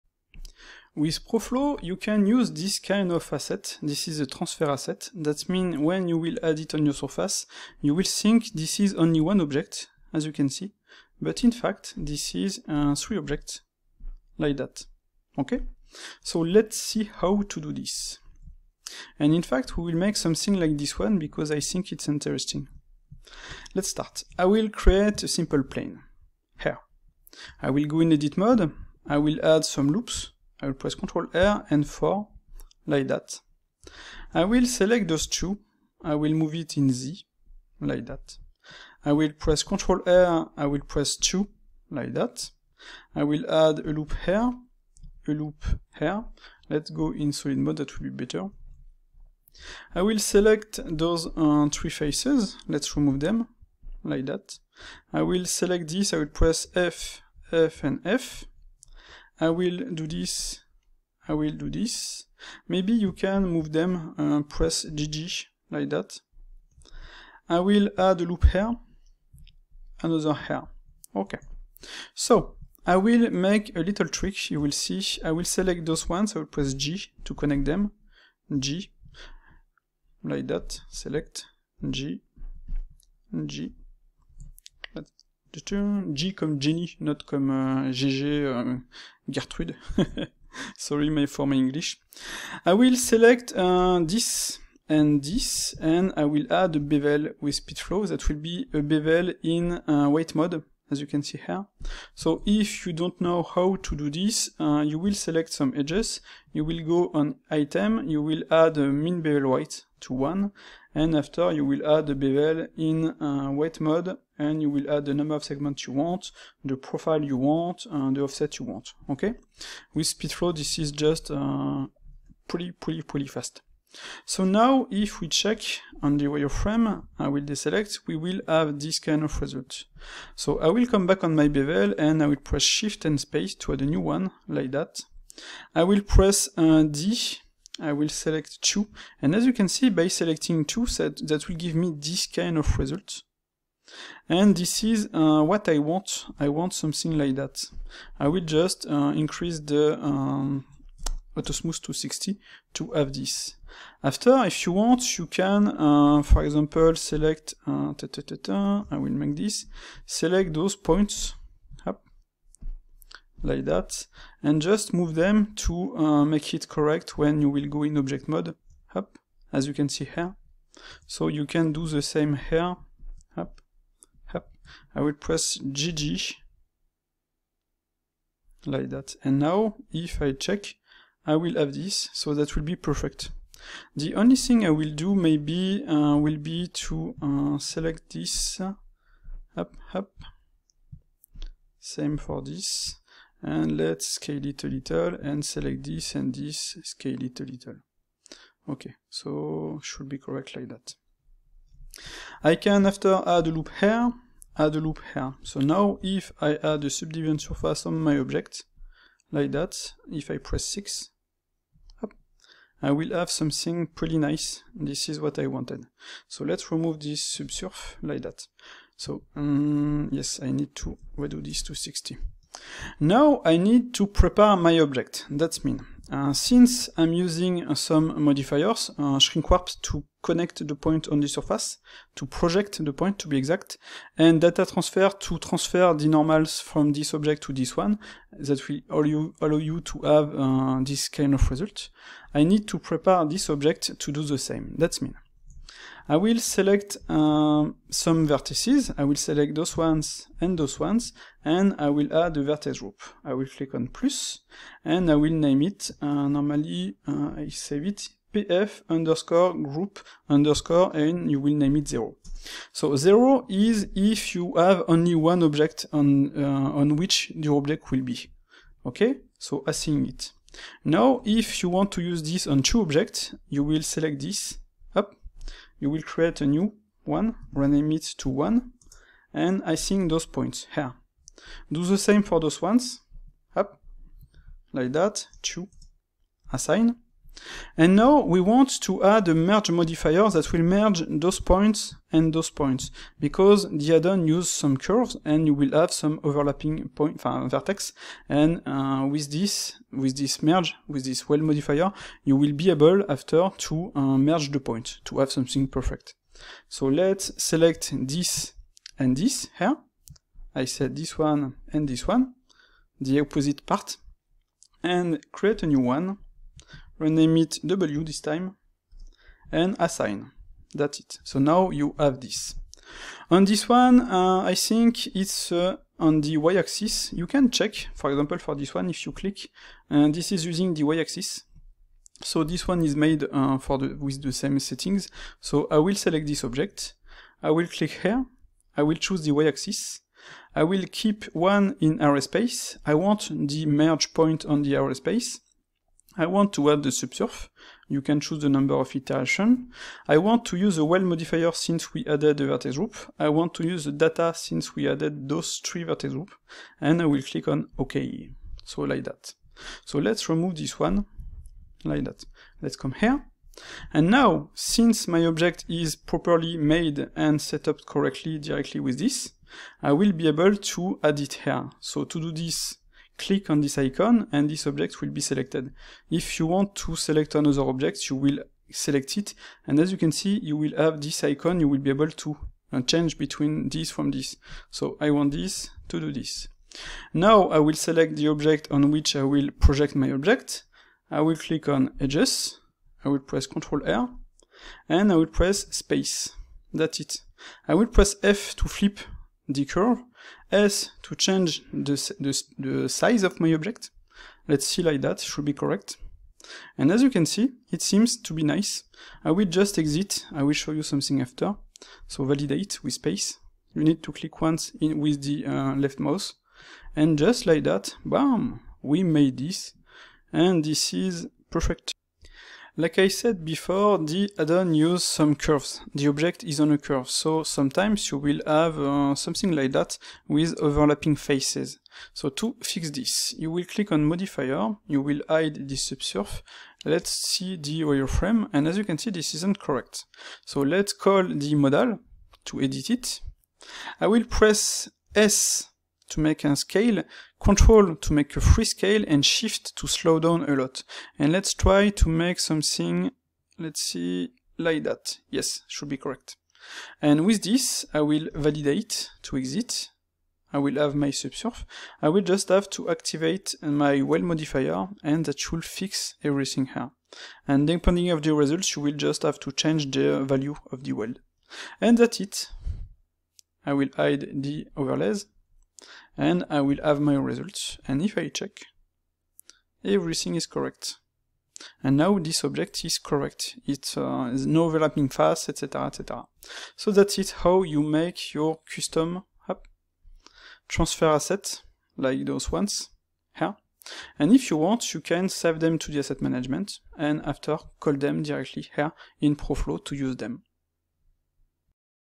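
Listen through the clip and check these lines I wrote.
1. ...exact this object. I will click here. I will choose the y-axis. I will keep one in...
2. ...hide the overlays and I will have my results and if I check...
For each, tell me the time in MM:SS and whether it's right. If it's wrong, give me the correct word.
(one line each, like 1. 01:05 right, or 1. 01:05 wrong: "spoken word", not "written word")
1. 05:35 wrong: "select", not "exact"
2. 07:53 right.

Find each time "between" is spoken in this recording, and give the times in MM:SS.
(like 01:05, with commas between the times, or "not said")
06:23.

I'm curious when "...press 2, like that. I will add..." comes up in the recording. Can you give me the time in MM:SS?
00:40.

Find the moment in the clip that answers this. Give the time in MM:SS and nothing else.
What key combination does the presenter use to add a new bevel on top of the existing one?
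02:12.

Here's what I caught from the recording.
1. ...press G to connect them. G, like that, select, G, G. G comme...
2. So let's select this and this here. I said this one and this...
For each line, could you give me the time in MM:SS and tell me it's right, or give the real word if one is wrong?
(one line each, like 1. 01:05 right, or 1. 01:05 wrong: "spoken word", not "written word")
1. 01:16 right
2. 05:06 right.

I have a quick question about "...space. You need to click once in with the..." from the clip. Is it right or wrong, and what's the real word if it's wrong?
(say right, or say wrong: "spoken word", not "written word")
right.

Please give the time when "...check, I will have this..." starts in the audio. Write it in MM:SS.
03:00.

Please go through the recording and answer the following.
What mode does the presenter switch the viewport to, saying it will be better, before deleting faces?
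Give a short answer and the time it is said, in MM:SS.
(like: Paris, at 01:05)
Solid mode, at 00:47.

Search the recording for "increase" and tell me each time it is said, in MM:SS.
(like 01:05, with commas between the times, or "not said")
02:29.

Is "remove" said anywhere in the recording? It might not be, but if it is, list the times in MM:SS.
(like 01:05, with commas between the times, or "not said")
00:52, 03:36, 06:00.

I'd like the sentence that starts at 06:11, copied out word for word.
So to do this, click on this icon and this object will be selected.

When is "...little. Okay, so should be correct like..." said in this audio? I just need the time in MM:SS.
03:17.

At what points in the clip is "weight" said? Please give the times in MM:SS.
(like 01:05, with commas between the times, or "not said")
01:40, 01:49, 01:53.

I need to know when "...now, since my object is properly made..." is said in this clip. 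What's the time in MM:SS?
06:04.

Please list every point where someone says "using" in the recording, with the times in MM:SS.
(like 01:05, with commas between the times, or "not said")
03:47, 05:30.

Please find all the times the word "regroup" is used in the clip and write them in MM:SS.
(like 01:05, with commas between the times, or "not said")
not said.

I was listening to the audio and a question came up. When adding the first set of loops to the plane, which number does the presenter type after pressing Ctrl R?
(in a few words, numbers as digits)
4.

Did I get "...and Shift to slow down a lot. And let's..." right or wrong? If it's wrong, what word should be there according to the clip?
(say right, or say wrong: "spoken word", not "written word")
right.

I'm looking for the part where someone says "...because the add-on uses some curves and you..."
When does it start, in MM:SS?
04:53.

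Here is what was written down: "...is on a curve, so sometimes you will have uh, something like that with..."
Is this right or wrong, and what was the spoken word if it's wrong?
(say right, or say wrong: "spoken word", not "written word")
right.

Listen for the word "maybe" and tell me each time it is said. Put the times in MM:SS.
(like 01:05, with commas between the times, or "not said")
01:02, 03:05.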